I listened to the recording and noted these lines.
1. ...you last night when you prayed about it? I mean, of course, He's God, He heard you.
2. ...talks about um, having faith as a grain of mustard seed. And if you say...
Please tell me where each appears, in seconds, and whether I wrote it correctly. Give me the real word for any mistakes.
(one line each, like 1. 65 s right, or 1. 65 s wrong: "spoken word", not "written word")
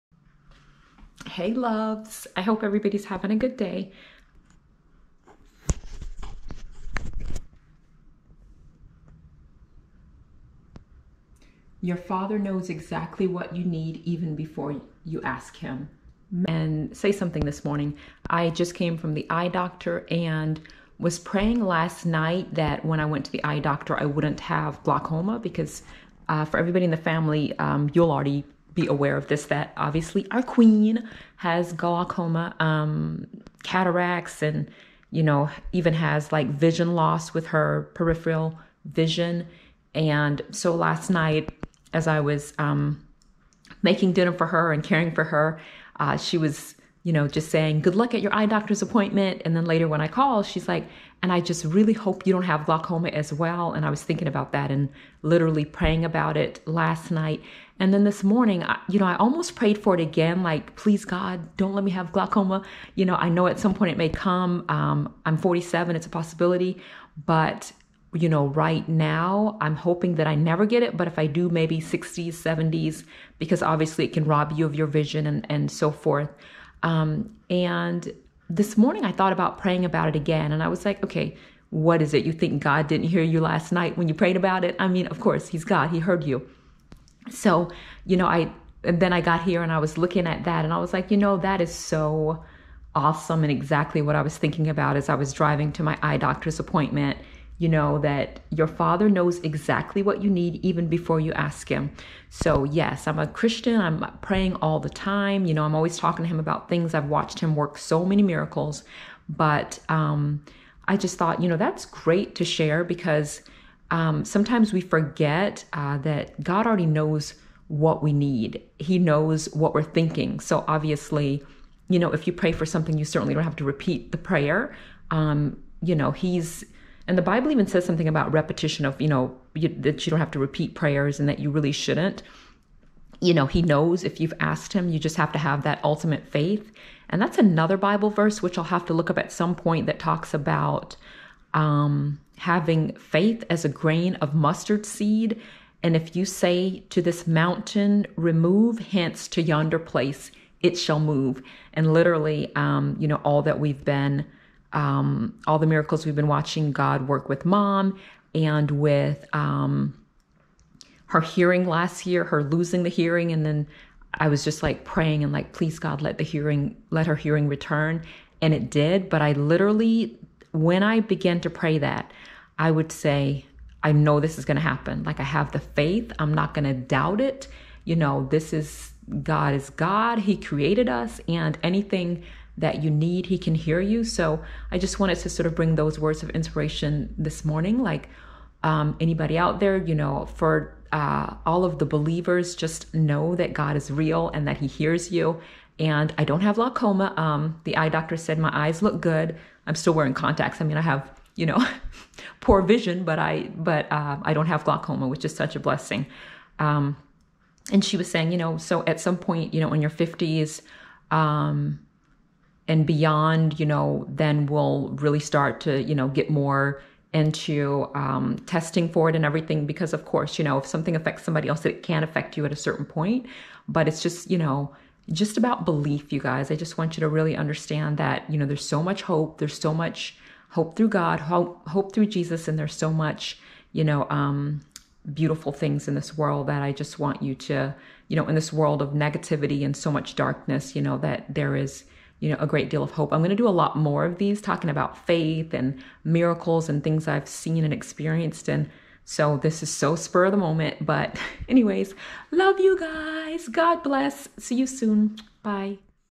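1. 83 s right
2. 139 s right.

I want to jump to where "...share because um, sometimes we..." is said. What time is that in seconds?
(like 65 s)
112 s.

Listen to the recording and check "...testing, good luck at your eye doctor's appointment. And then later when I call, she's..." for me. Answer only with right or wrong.
wrong.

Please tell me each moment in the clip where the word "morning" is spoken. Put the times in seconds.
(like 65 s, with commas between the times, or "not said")
17 s, 58 s, 78 s, 187 s.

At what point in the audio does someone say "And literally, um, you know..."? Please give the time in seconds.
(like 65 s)
151 s.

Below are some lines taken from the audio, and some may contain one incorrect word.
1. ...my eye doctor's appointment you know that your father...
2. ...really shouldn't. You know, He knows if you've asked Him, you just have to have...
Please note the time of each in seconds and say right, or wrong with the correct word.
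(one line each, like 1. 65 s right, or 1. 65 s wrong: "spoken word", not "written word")
1. 95 s right
2. 131 s right.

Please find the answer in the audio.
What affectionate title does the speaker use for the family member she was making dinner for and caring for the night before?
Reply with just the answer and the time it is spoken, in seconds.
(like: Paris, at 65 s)
queen, at 30 s.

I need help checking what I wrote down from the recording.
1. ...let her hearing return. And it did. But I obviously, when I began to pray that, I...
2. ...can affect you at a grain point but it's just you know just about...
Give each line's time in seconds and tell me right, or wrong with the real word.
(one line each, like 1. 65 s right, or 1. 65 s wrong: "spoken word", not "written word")
1. 166 s wrong: "literally", not "obviously"
2. 221 s wrong: "certain", not "grain".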